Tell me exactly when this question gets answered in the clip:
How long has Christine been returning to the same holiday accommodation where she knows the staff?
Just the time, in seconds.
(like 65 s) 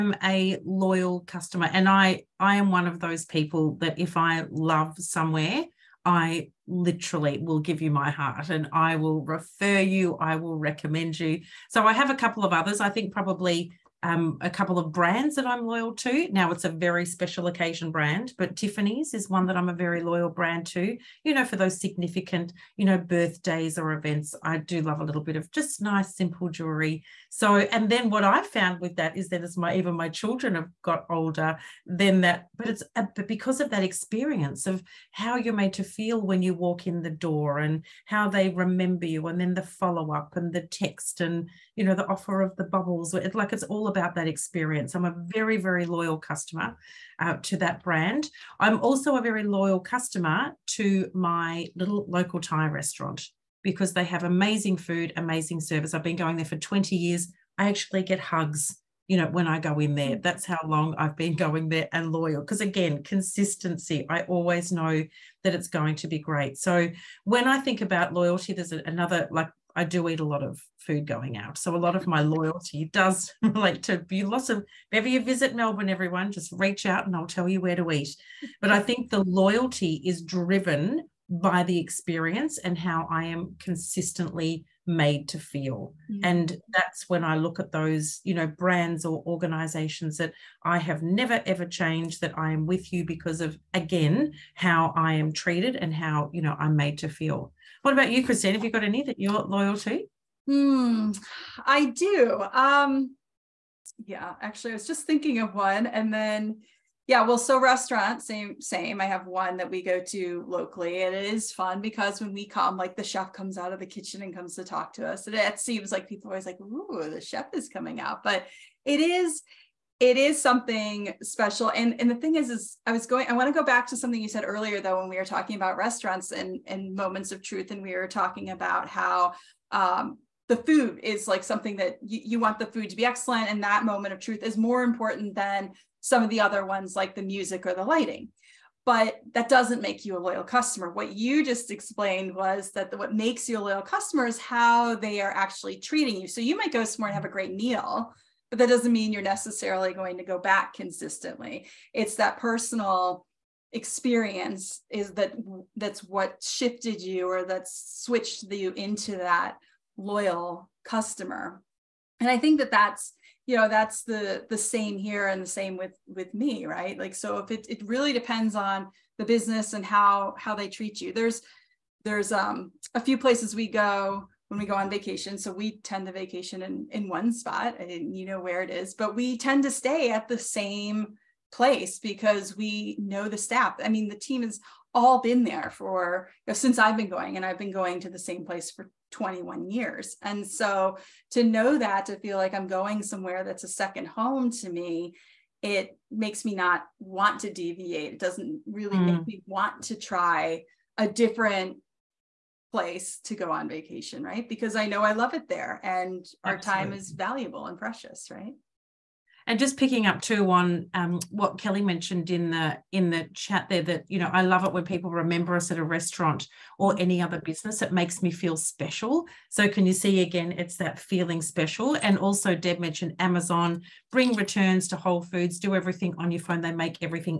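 189 s.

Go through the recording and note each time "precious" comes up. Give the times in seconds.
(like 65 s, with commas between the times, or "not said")
207 s.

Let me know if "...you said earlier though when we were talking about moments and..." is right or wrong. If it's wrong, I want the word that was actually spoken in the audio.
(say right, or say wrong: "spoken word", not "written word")
wrong: "restaurants", not "moments".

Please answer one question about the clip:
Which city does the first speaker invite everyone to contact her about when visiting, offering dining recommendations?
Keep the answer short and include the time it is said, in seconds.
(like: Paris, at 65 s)
Melbourne, at 75 s.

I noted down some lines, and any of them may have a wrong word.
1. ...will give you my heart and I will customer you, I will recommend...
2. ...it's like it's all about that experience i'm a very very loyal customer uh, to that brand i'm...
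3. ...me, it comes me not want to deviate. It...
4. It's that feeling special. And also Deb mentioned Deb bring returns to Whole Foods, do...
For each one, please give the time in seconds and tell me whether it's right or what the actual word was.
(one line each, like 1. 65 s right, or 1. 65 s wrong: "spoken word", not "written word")
1. 7 s wrong: "refer", not "customer"
2. 43 s right
3. 194 s wrong: "makes", not "comes"
4. 220 s wrong: "Amazon", not "Deb".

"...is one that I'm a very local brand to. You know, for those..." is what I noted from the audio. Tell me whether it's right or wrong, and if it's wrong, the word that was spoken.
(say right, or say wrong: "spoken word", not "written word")
wrong: "loyal", not "local".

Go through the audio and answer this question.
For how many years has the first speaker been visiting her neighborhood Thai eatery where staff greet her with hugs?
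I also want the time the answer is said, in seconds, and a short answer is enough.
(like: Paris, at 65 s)
20 years, at 56 s.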